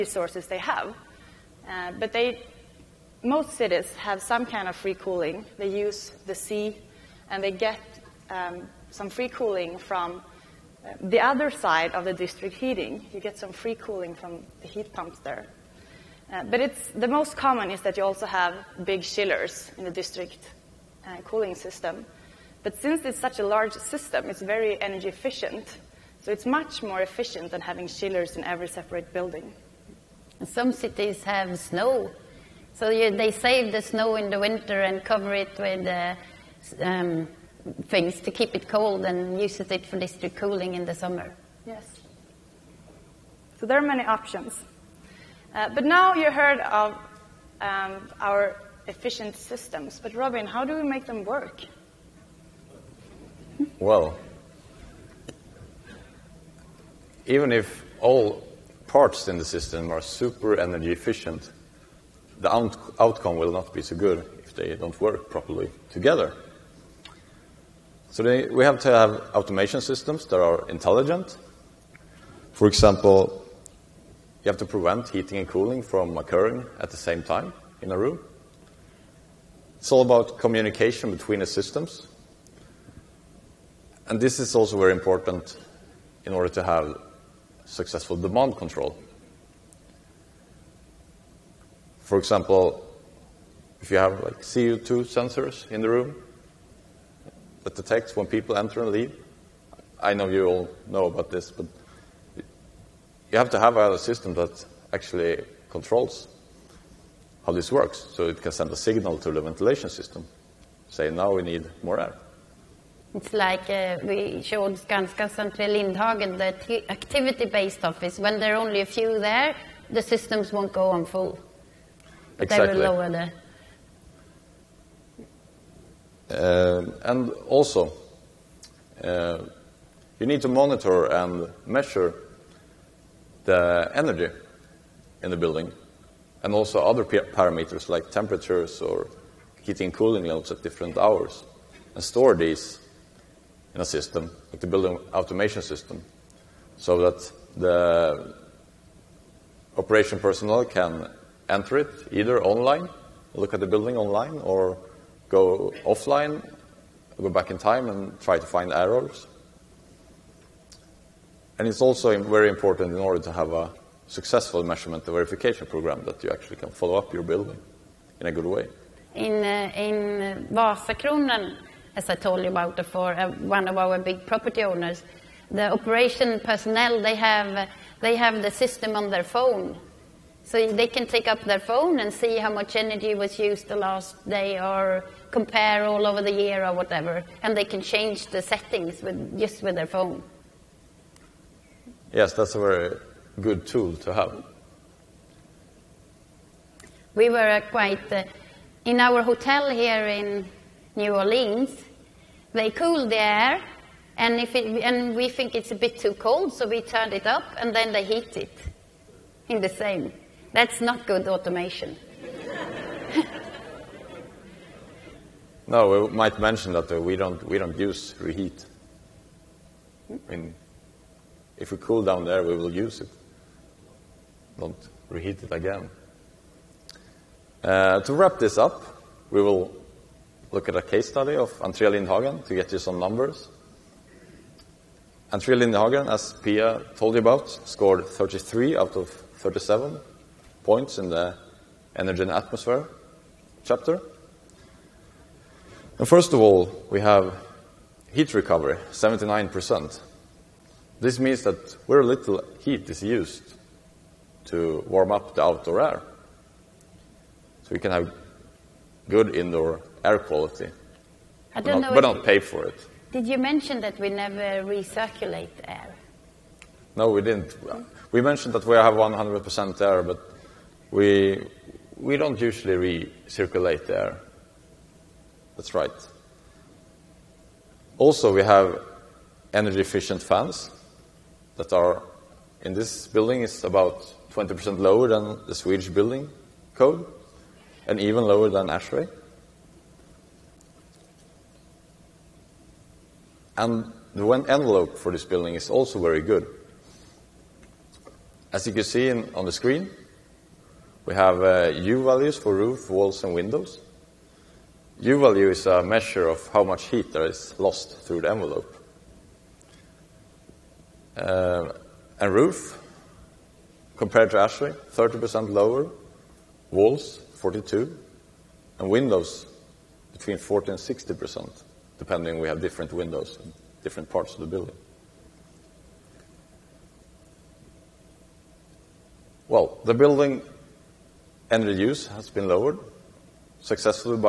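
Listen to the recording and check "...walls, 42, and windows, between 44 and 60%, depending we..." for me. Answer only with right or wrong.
wrong.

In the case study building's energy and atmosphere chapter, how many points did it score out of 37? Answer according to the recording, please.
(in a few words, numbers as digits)
33.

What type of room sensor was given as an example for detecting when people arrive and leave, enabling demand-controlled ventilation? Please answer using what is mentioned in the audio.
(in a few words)
CO2 sensors.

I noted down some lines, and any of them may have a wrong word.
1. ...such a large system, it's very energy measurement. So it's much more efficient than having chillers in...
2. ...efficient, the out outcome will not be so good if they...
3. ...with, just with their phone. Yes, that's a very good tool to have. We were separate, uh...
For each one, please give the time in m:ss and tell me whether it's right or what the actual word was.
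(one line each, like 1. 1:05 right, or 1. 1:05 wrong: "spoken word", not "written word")
1. 0:23 wrong: "efficient", not "measurement"
2. 1:00 right
3. 3:09 wrong: "quite", not "separate".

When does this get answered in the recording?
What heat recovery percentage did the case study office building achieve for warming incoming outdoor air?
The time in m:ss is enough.
4:08.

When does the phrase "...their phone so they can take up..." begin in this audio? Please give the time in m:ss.
2:59.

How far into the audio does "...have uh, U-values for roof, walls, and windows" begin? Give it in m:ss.
5:01.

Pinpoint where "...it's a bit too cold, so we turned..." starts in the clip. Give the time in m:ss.
3:25.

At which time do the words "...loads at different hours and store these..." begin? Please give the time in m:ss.
2:20.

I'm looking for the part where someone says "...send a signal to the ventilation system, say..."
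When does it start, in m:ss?
1:48.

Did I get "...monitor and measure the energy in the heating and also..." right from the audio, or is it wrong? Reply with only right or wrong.
wrong.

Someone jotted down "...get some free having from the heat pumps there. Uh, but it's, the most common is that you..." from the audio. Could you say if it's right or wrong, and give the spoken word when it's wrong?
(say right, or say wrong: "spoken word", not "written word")
wrong: "cooling", not "having".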